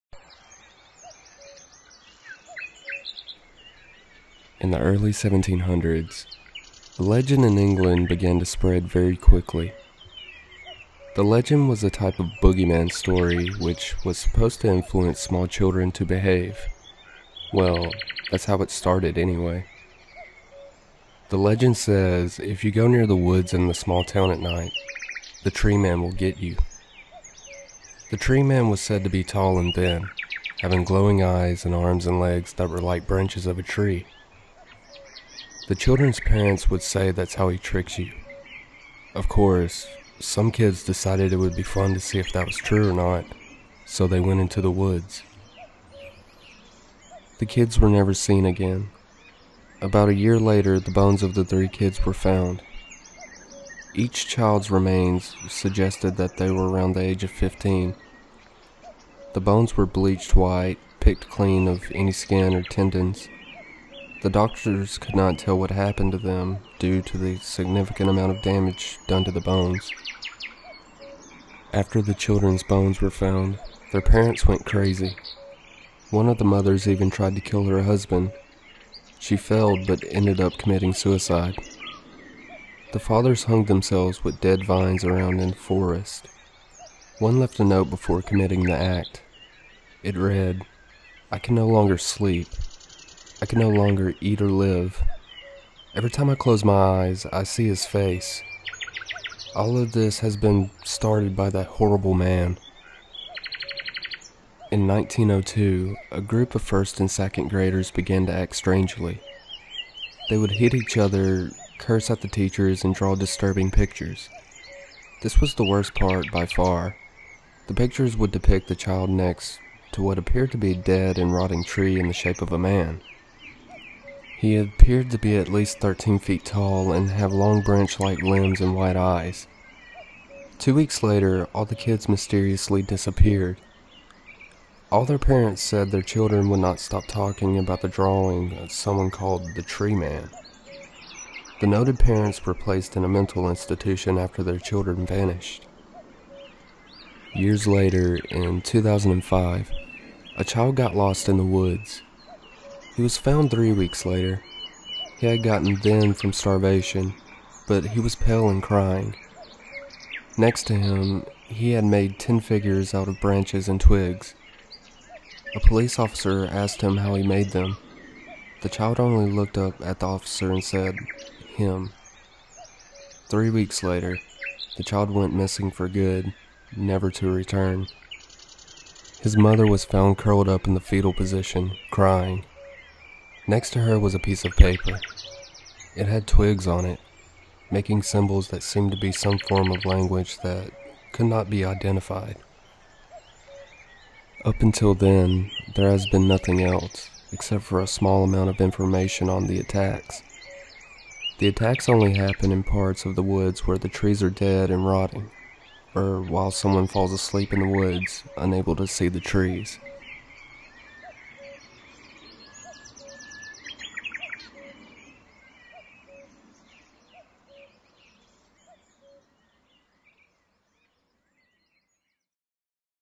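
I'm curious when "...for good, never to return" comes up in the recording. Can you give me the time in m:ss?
2:55.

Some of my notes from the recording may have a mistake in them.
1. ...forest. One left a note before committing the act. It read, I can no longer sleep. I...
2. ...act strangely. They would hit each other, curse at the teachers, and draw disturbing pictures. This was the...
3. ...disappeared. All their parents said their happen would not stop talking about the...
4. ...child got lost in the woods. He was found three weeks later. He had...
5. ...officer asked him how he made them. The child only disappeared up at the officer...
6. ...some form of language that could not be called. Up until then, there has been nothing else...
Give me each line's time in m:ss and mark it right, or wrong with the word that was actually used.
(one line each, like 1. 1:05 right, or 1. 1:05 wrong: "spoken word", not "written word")
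1. 1:25 right
2. 1:48 right
3. 2:12 wrong: "children", not "happen"
4. 2:30 right
5. 2:45 wrong: "looked", not "disappeared"
6. 3:09 wrong: "identified", not "called".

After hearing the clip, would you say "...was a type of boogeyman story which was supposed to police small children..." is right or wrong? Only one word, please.
wrong.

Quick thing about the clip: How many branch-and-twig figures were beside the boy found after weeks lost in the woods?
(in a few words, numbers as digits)
10.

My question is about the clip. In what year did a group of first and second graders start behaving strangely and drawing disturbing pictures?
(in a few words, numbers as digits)
1902.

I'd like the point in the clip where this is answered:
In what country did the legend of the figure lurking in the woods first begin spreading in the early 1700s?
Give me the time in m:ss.
0:07.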